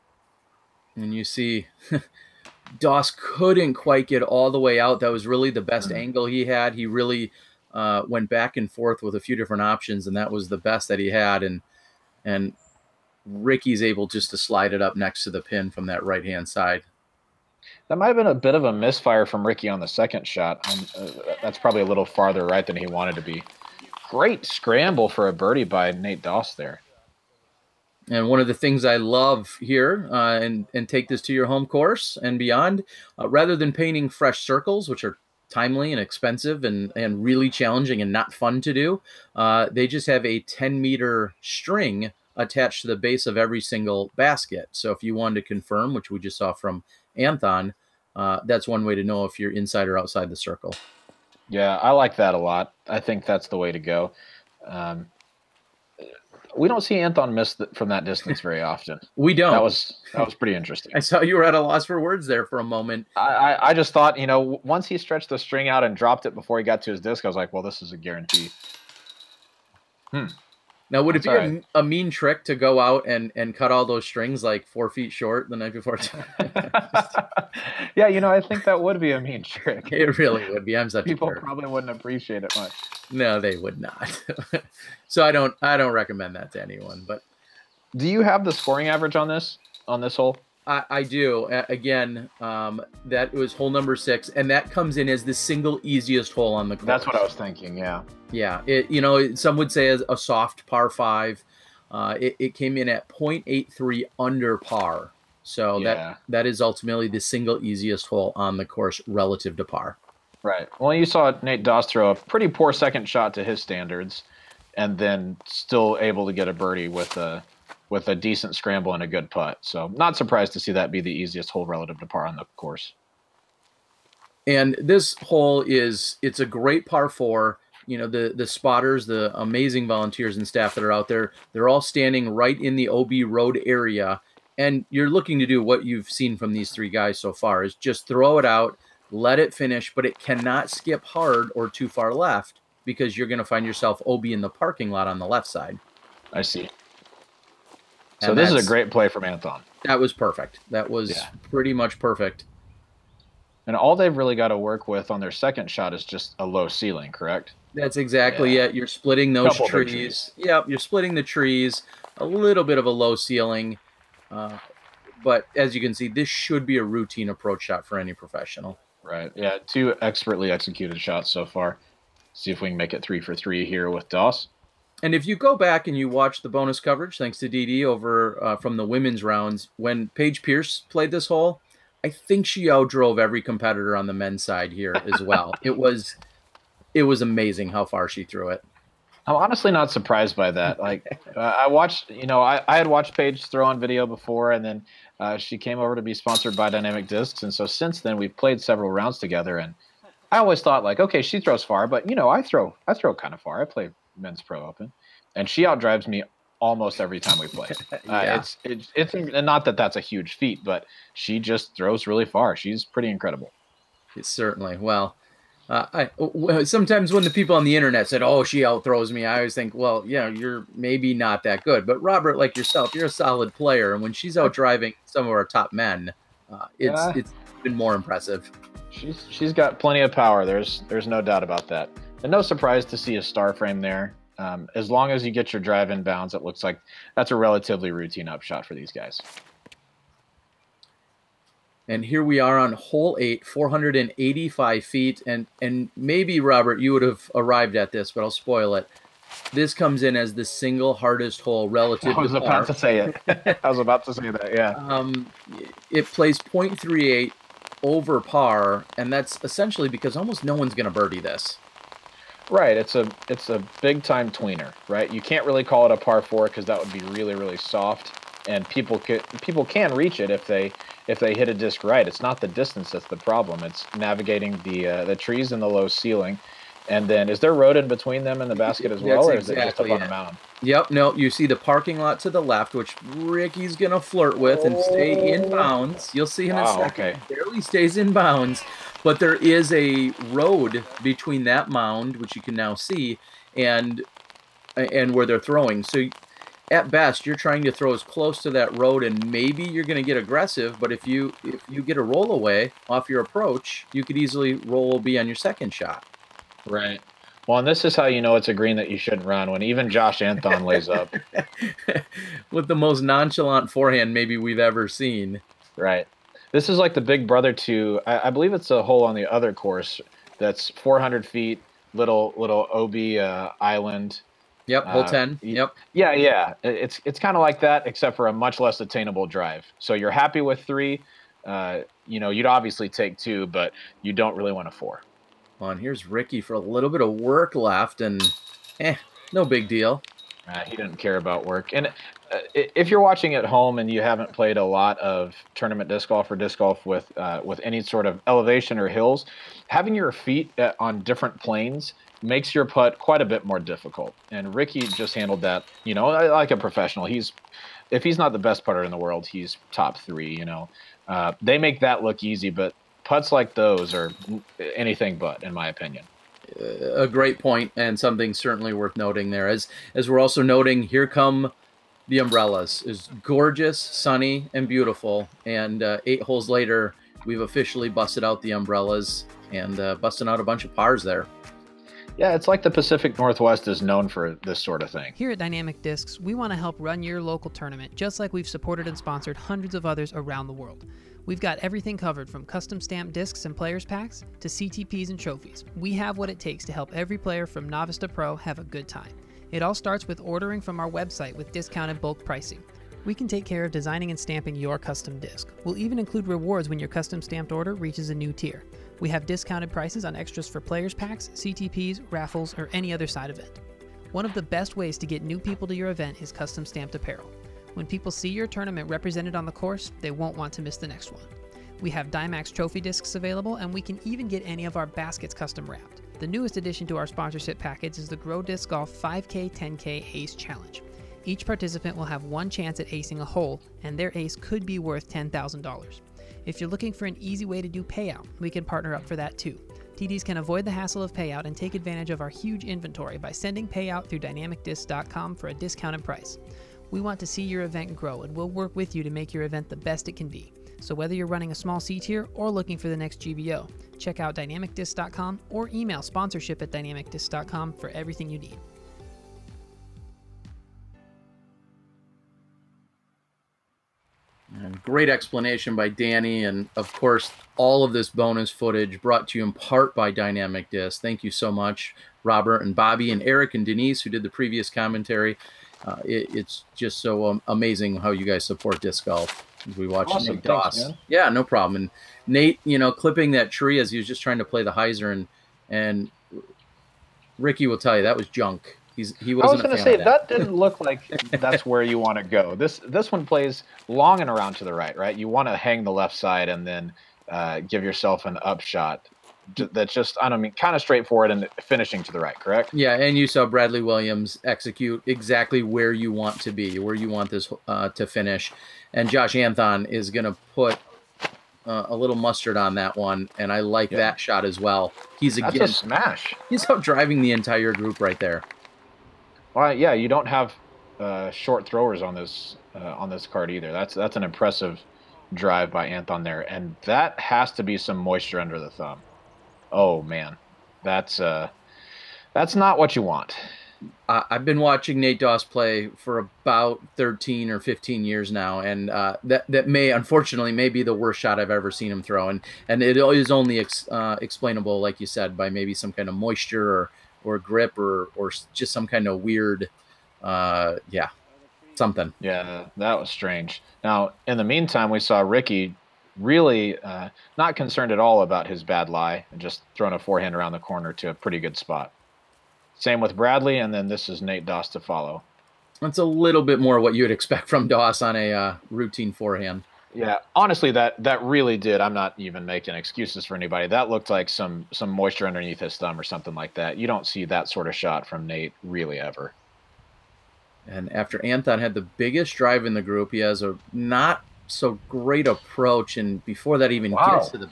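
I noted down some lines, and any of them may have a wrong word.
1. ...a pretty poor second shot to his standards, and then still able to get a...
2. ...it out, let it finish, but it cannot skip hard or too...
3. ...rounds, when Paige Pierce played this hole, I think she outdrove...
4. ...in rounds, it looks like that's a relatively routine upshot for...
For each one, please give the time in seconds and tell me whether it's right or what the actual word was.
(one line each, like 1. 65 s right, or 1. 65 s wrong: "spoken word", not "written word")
1. 112 s right
2. 138 s right
3. 179 s right
4. 235 s wrong: "bounds", not "rounds".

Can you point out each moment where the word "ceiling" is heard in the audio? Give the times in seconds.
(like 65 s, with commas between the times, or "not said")
156 s, 163 s, 275 s.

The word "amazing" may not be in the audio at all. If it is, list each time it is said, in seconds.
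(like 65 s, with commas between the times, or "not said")
129 s, 187 s, 477 s.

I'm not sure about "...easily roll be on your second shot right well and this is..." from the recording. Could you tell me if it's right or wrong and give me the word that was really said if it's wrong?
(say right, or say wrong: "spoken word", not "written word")
right.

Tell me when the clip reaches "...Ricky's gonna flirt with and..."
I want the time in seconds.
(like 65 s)
283 s.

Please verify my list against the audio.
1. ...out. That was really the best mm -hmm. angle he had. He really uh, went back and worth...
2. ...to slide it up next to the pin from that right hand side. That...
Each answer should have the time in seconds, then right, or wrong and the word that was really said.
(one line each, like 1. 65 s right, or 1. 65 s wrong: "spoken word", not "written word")
1. 4 s wrong: "forth", not "worth"
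2. 14 s right.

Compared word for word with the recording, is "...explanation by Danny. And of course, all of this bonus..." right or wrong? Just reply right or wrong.
right.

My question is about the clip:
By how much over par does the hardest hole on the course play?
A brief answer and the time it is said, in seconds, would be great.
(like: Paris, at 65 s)
0.38, at 256 s.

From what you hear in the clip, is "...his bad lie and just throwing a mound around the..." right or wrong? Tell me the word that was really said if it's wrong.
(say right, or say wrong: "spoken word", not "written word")
wrong: "forehand", not "mound".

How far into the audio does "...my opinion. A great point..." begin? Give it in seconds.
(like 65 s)
365 s.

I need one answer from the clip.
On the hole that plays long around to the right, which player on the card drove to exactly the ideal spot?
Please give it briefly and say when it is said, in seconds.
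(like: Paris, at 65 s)
Bradley Williams, at 503 s.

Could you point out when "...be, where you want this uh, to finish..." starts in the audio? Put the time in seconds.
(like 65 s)
506 s.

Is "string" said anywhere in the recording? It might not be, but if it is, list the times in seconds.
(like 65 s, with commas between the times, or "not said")
41 s, 65 s, 74 s.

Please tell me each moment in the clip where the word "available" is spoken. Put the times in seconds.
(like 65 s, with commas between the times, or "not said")
423 s.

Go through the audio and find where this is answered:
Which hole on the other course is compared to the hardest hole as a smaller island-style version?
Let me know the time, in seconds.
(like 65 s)
324 s.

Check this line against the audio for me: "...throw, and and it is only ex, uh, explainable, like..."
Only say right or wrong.
right.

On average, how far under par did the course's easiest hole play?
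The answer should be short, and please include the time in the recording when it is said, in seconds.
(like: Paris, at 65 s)
0.83, at 103 s.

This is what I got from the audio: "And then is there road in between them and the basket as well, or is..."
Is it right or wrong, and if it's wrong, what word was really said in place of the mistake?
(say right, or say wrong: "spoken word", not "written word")
right.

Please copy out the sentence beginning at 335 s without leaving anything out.
On here's Ricky for a little bit of work left, and eh, no big deal.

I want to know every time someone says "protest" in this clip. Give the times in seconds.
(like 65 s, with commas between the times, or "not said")
not said.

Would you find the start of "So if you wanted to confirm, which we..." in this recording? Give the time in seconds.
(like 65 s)
44 s.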